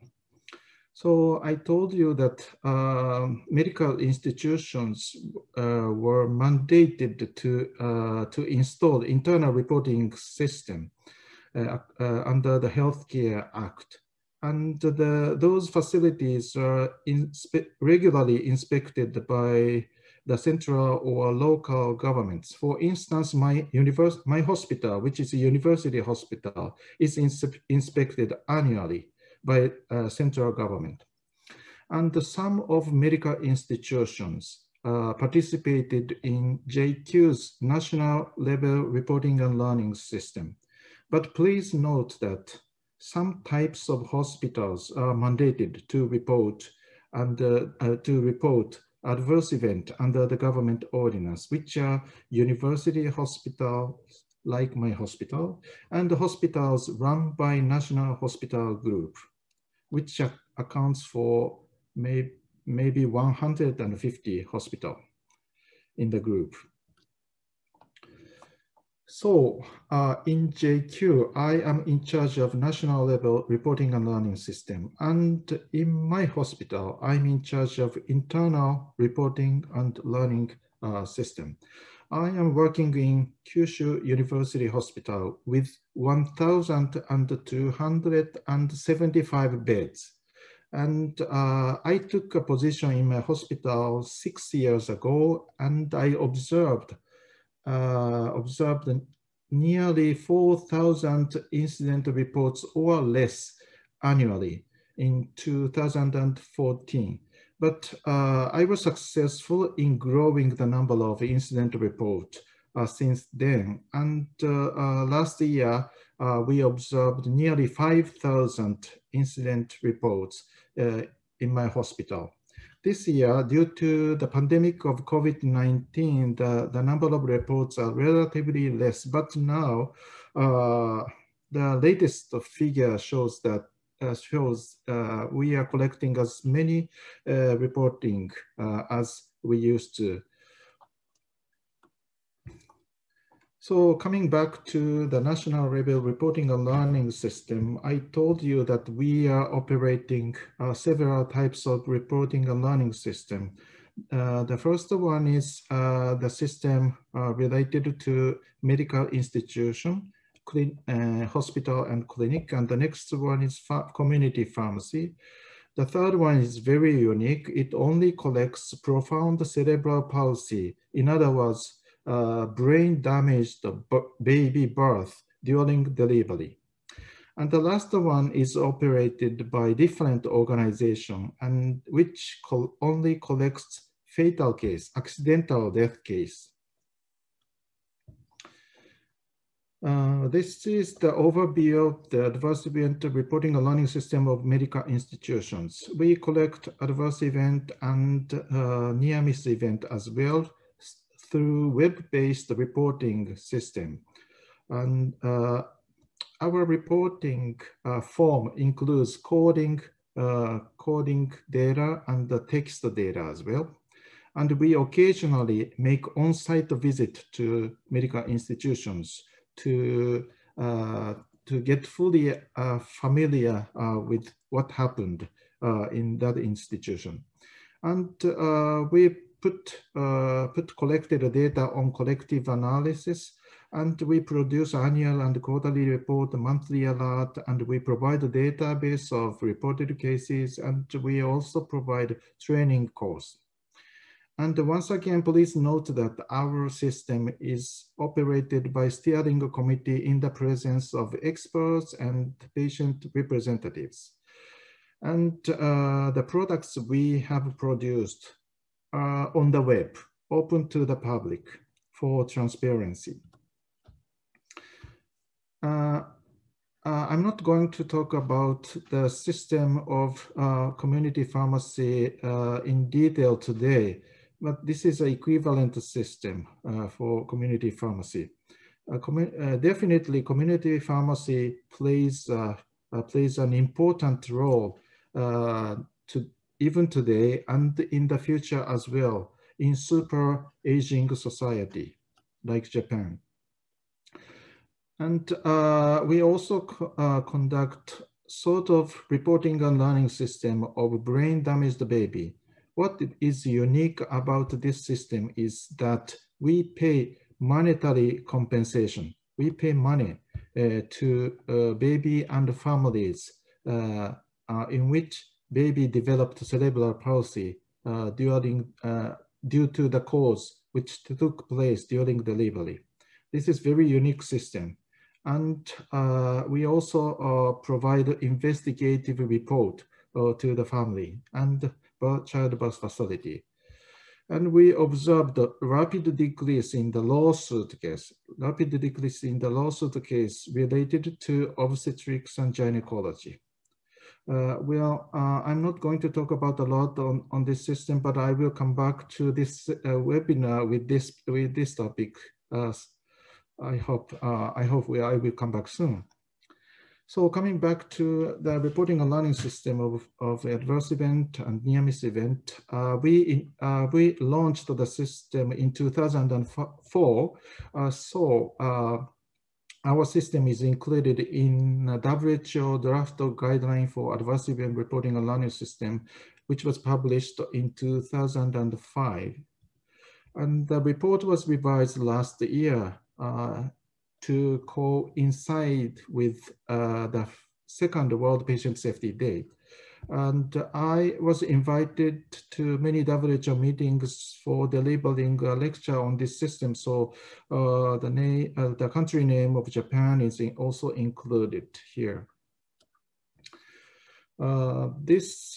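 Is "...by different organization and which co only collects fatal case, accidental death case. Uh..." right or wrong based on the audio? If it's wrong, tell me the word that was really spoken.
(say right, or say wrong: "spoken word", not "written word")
right.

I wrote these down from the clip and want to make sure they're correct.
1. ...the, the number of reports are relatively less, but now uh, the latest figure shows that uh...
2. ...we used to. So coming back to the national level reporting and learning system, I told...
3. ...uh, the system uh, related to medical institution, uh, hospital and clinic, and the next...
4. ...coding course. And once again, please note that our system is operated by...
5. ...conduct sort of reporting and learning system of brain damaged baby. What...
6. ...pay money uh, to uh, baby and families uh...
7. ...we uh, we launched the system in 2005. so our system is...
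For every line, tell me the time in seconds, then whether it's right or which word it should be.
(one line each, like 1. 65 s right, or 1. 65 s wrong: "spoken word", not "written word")
1. 126 s right
2. 139 s right
3. 155 s right
4. 242 s wrong: "training", not "coding"
5. 297 s right
6. 309 s right
7. 362 s wrong: "2004", not "2005".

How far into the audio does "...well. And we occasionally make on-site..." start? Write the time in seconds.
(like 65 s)
213 s.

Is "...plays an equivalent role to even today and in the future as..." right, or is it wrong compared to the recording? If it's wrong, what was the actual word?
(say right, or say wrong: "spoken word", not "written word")
wrong: "important", not "equivalent".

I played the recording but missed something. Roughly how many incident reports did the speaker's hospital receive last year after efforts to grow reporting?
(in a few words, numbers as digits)
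5,000.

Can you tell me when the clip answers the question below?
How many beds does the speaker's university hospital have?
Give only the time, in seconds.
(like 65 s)
85 s.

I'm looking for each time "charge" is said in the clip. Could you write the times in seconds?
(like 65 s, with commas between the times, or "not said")
72 s, 77 s.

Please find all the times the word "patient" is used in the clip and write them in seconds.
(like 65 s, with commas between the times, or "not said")
252 s, 388 s.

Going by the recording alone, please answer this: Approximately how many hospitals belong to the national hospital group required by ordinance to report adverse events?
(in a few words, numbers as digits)
150.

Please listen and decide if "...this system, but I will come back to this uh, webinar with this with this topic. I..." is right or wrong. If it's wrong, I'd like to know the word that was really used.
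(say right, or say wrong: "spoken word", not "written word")
right.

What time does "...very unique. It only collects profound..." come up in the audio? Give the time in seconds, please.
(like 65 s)
166 s.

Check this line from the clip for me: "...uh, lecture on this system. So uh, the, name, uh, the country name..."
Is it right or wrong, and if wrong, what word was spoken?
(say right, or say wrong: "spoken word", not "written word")
right.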